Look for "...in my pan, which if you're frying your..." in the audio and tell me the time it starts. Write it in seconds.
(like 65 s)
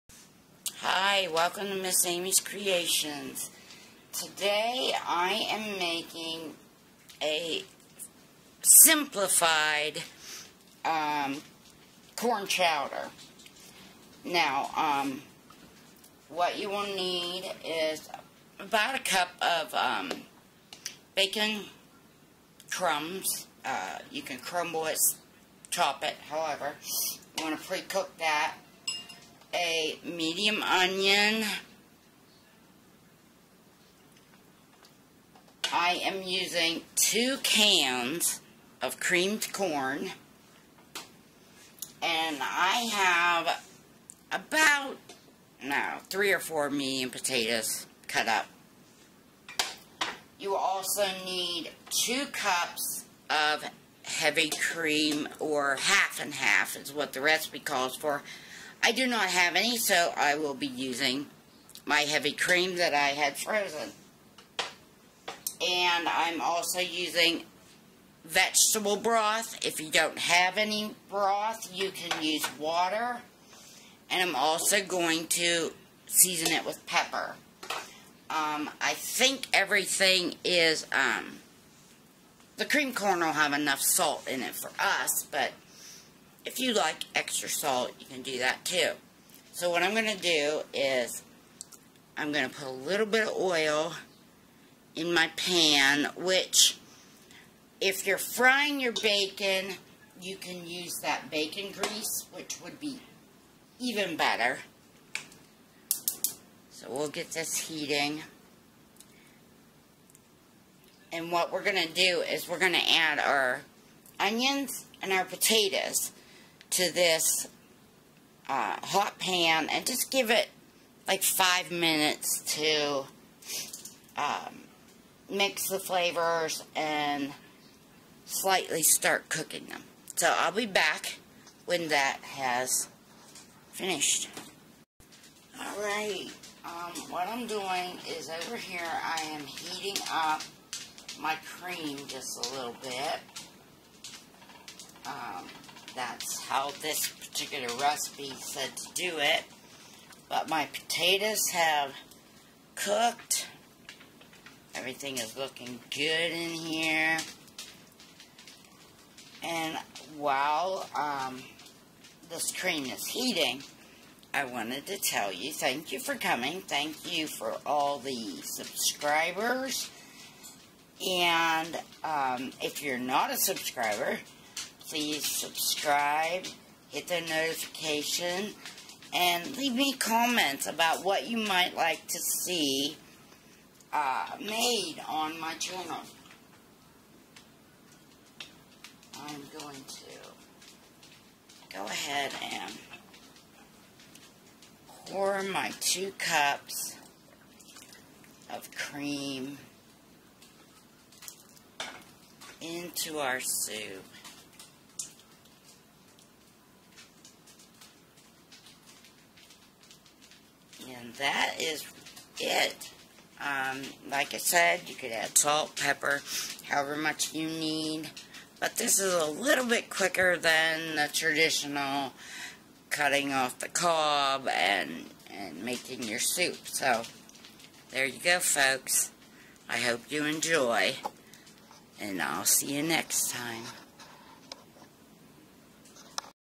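94 s.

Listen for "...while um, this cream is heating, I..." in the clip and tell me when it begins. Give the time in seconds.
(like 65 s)
160 s.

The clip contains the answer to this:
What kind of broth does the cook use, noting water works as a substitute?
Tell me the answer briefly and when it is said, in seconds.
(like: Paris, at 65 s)
Vegetable broth, at 68 s.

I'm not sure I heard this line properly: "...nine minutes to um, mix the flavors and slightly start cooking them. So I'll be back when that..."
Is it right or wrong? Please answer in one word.
wrong.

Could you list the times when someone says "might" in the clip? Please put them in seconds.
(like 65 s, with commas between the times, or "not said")
181 s.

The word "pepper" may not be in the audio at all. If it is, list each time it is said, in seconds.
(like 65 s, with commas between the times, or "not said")
76 s, 215 s.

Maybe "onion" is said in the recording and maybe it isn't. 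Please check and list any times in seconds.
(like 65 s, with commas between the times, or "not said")
30 s, 114 s.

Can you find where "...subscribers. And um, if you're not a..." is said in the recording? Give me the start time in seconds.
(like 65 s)
168 s.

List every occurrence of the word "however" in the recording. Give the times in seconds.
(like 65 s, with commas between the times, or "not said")
26 s, 216 s.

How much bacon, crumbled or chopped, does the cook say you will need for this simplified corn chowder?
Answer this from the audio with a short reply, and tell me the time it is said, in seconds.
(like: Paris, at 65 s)
1 cup, at 18 s.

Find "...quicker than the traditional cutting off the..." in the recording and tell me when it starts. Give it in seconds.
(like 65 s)
219 s.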